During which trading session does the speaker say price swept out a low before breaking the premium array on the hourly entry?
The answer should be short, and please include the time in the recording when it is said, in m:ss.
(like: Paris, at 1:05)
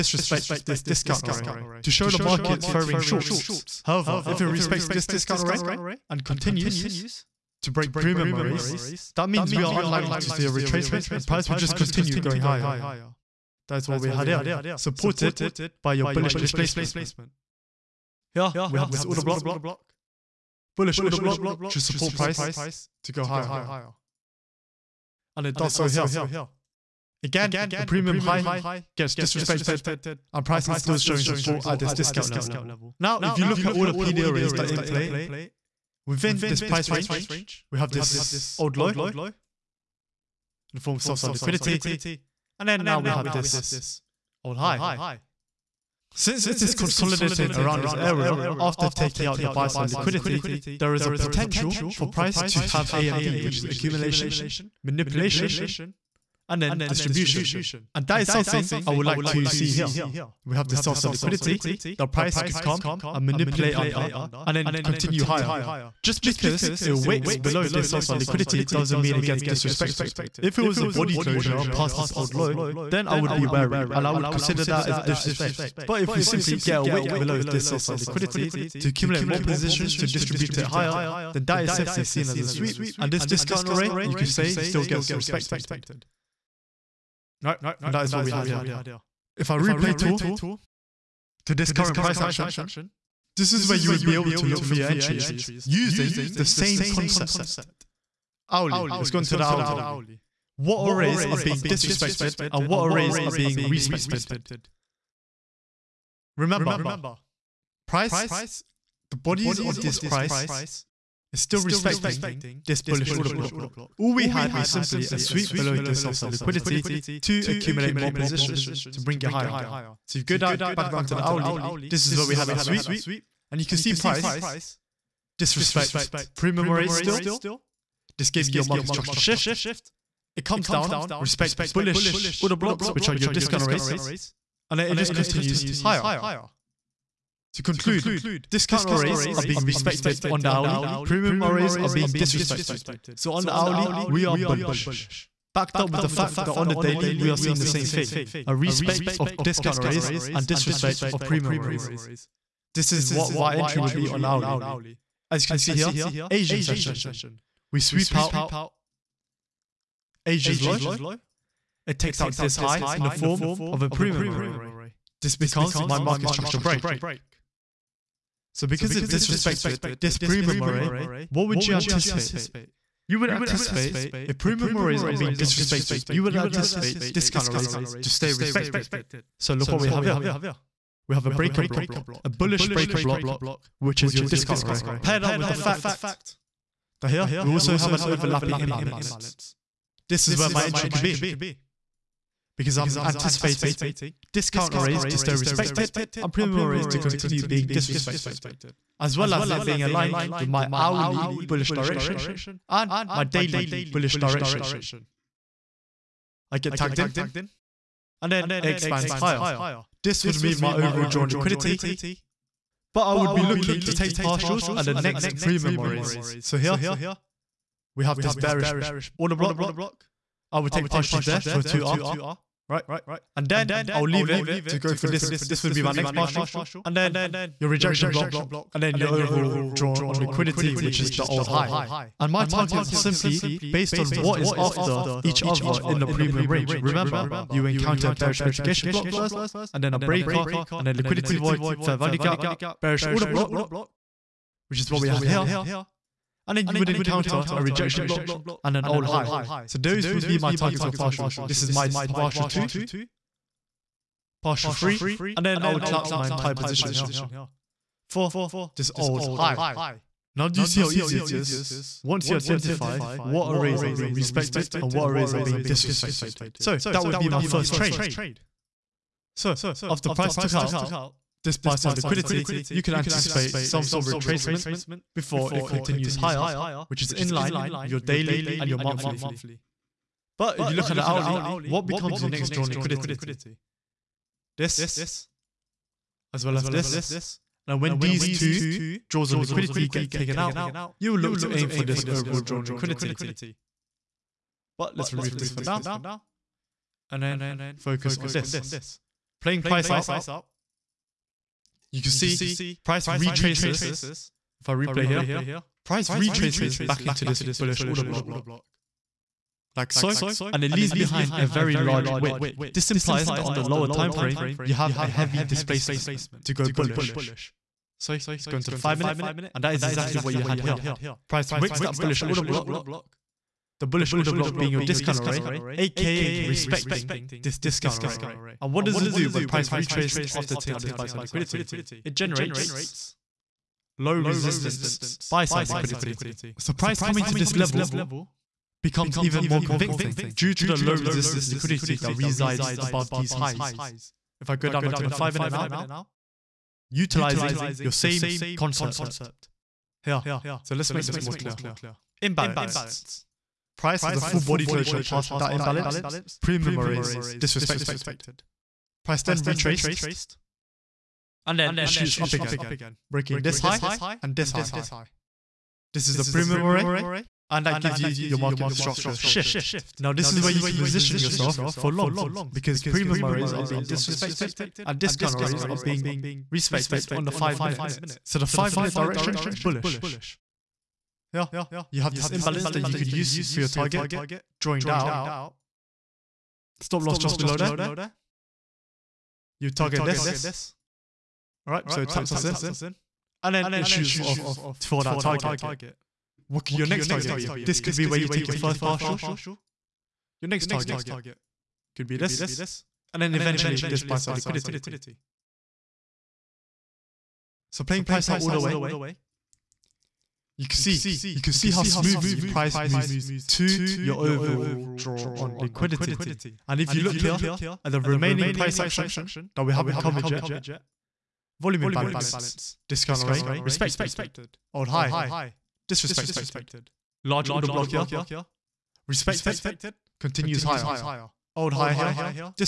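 Asian session, at 2:36.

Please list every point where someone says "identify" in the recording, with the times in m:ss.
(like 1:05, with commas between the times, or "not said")
4:22.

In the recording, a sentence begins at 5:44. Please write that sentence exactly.
If I go down onto the 5 minute now, utilizing your same concept.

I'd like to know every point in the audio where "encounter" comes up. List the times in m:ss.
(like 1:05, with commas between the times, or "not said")
3:57, 4:06.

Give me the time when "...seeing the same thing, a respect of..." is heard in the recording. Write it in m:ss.
2:27.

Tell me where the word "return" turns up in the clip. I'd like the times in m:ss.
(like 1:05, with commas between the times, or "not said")
not said.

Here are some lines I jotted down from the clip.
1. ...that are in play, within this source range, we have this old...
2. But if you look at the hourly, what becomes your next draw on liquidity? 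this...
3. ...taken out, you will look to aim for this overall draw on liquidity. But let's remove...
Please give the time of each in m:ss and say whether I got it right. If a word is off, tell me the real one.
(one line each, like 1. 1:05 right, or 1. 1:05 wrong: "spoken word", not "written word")
1. 0:34 wrong: "price", not "source"
2. 4:40 right
3. 4:50 right.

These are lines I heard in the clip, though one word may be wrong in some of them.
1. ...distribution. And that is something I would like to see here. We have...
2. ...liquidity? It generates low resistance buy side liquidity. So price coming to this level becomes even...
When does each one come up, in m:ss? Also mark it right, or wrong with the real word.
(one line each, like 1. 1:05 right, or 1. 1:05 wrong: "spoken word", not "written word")
1. 0:56 right
2. 5:31 right.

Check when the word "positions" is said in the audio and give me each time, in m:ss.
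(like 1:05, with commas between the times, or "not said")
1:19, 1:58, 4:16, 6:10.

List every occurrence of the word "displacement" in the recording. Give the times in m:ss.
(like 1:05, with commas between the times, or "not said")
0:16, 5:15.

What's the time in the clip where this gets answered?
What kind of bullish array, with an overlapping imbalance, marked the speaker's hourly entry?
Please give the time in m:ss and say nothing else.
3:02.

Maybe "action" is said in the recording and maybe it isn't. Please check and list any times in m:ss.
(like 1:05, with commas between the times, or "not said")
1:32, 6:58.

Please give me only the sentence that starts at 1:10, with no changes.
If it was a body closure past this old low, then I would be wary, and I would consider that as disrespect.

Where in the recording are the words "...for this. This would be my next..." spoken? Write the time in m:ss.
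3:44.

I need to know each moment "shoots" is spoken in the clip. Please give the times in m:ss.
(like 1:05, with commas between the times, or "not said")
6:01, 6:33.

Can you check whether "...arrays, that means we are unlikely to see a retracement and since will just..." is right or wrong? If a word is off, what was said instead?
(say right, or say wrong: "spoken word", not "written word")
wrong: "price", not "since".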